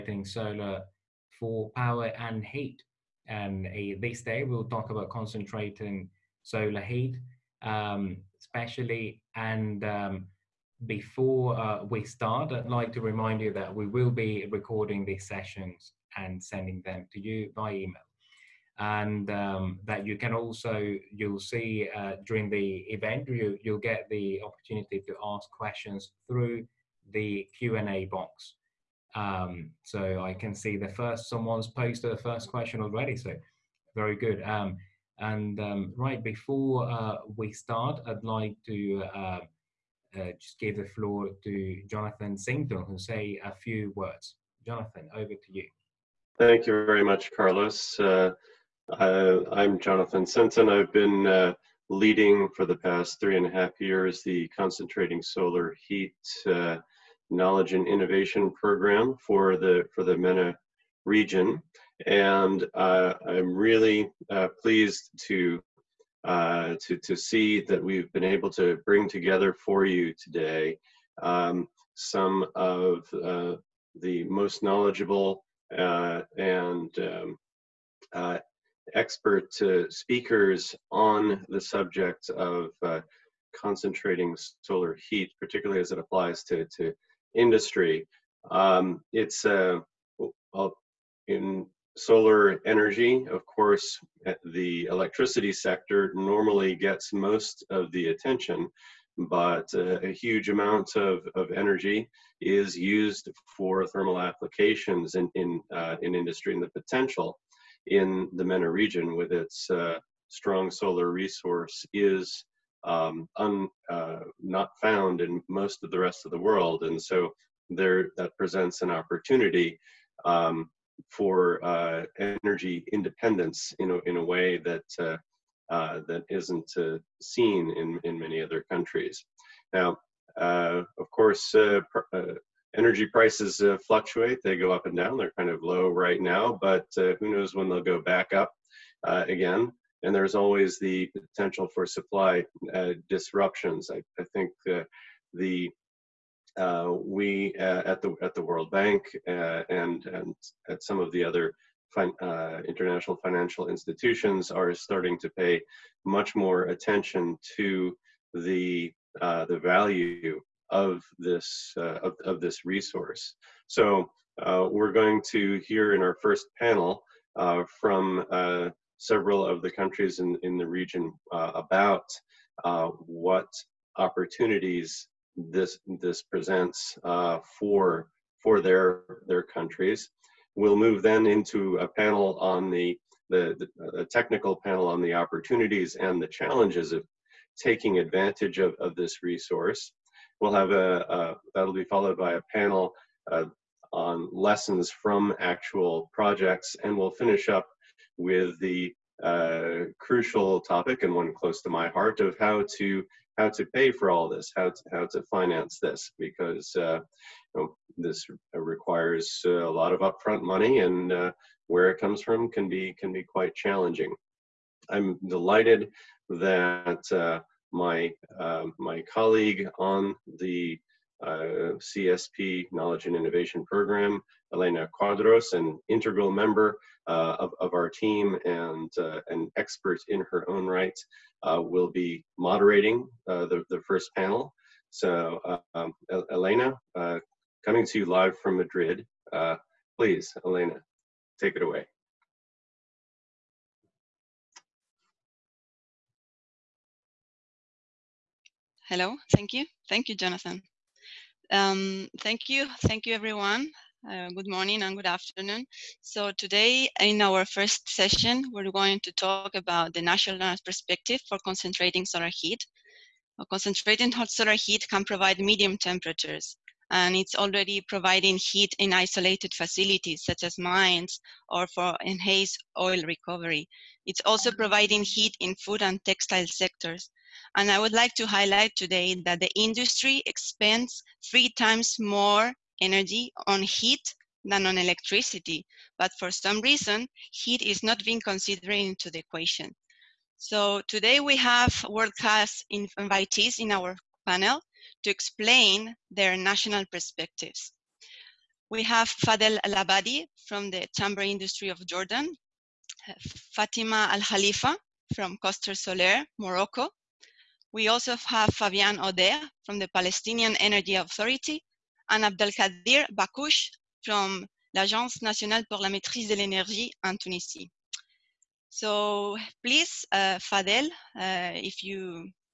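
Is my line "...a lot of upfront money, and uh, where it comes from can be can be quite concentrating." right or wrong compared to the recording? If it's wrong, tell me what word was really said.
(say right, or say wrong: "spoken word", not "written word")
wrong: "challenging", not "concentrating".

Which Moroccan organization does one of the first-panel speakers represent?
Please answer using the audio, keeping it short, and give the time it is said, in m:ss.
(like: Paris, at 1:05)
Cluster Solaire, at 5:05.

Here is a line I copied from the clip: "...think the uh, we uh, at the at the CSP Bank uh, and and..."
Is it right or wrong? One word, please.
wrong.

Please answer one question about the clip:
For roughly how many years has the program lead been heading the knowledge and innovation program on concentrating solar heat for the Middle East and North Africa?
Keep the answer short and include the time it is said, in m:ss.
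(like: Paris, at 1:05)
3.5 years, at 0:53.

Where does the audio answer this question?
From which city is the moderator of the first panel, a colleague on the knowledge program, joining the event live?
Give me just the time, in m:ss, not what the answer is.
3:58.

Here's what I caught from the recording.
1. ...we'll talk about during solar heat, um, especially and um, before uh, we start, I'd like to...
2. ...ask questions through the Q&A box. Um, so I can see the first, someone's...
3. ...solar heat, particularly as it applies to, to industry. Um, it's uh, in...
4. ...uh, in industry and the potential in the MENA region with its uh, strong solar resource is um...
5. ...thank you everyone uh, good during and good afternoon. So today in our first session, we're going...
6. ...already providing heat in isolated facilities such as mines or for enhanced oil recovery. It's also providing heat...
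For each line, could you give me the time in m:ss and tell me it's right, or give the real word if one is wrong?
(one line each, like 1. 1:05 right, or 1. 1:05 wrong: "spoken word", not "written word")
1. 0:04 wrong: "concentrating", not "during"
2. 0:25 right
3. 1:24 right
4. 1:45 right
5. 4:12 wrong: "morning", not "during"
6. 4:27 right.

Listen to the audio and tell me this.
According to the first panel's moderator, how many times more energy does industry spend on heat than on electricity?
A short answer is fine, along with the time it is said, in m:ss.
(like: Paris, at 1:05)
3, at 4:41.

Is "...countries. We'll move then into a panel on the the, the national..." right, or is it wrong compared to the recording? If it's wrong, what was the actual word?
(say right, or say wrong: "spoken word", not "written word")
wrong: "technical", not "national".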